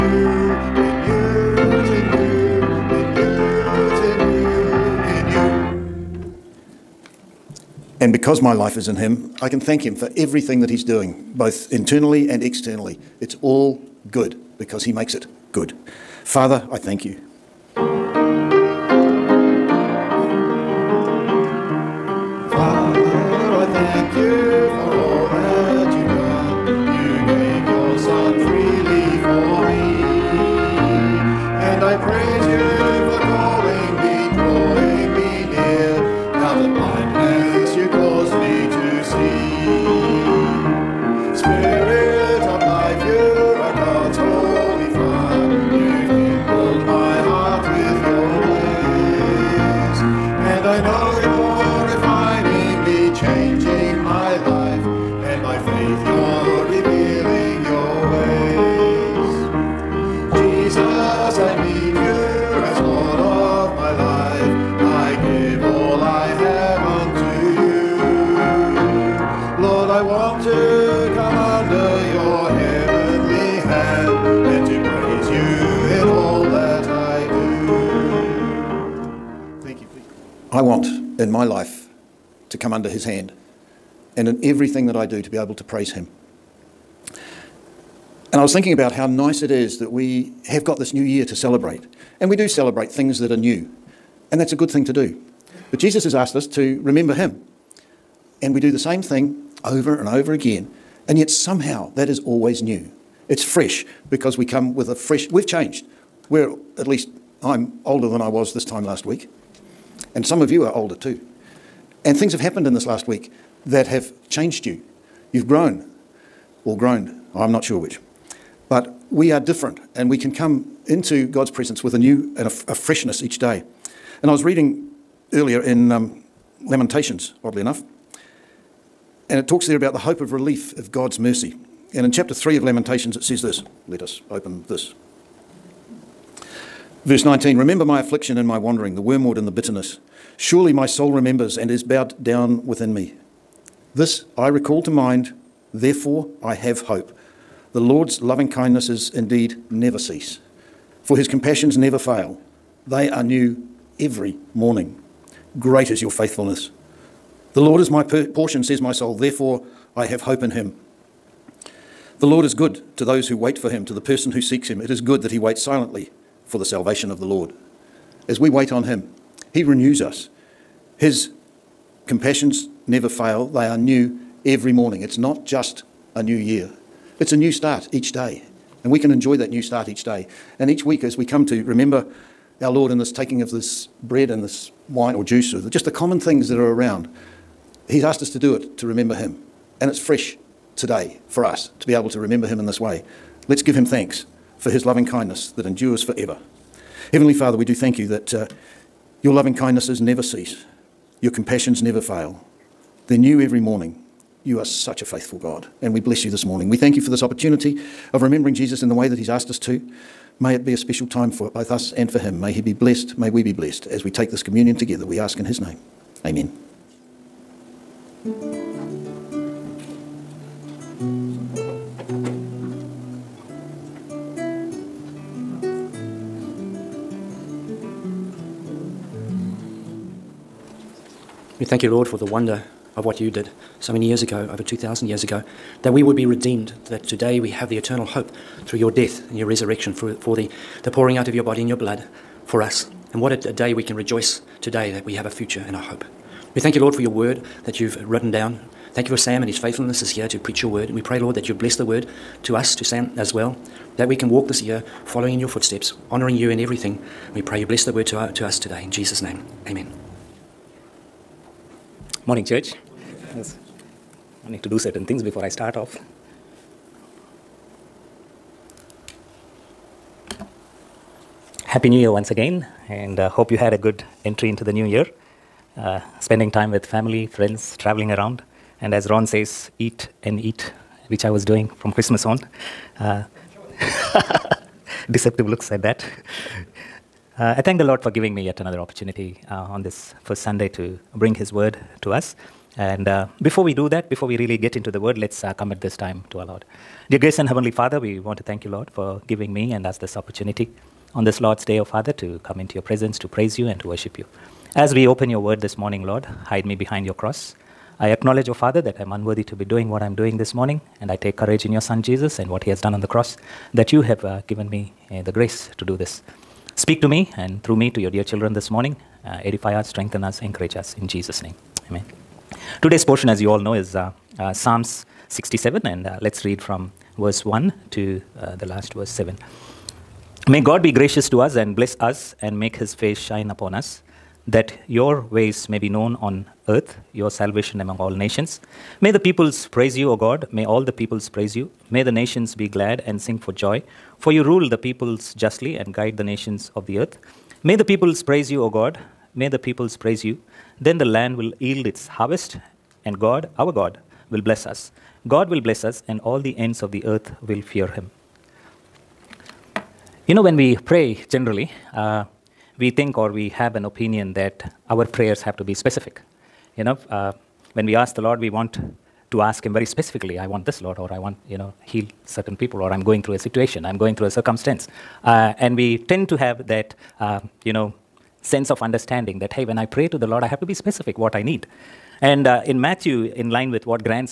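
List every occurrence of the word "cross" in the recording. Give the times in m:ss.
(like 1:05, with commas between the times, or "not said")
5:07, 5:13.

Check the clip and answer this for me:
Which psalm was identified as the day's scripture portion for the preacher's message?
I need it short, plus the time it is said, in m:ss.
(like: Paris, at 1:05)
Psalm 67, at 5:24.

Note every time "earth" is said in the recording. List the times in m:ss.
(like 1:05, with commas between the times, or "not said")
5:36, 5:46, 5:57.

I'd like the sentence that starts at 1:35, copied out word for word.
But Jesus has asked us to remember him.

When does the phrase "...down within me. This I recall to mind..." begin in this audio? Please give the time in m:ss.
2:22.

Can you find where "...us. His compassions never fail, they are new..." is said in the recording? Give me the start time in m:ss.
2:50.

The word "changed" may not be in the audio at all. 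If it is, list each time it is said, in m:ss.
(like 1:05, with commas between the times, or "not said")
1:45, 1:54.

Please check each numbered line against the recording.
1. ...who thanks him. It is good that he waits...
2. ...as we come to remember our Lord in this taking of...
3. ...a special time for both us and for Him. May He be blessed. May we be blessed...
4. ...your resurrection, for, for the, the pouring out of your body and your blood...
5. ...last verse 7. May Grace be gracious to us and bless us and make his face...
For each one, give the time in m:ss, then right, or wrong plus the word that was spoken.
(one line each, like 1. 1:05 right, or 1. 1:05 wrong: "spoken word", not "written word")
1. 2:44 wrong: "seeks", not "thanks"
2. 3:01 right
3. 3:30 right
4. 3:59 right
5. 5:28 wrong: "God", not "Grace".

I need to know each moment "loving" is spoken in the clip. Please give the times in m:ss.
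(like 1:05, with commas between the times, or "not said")
2:28, 3:14, 3:19.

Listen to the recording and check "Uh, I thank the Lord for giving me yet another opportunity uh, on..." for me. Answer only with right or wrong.
right.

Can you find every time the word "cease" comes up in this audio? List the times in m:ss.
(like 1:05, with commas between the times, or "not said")
2:29, 3:20.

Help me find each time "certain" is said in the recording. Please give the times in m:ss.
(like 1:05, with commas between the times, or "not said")
4:24, 6:12.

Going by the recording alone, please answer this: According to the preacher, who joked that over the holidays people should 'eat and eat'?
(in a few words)
Ron.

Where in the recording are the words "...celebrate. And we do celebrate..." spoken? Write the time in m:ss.
1:31.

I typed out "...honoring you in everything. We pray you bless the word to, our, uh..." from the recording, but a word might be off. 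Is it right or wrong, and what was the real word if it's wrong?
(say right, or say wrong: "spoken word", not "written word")
right.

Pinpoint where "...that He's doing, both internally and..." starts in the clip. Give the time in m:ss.
0:10.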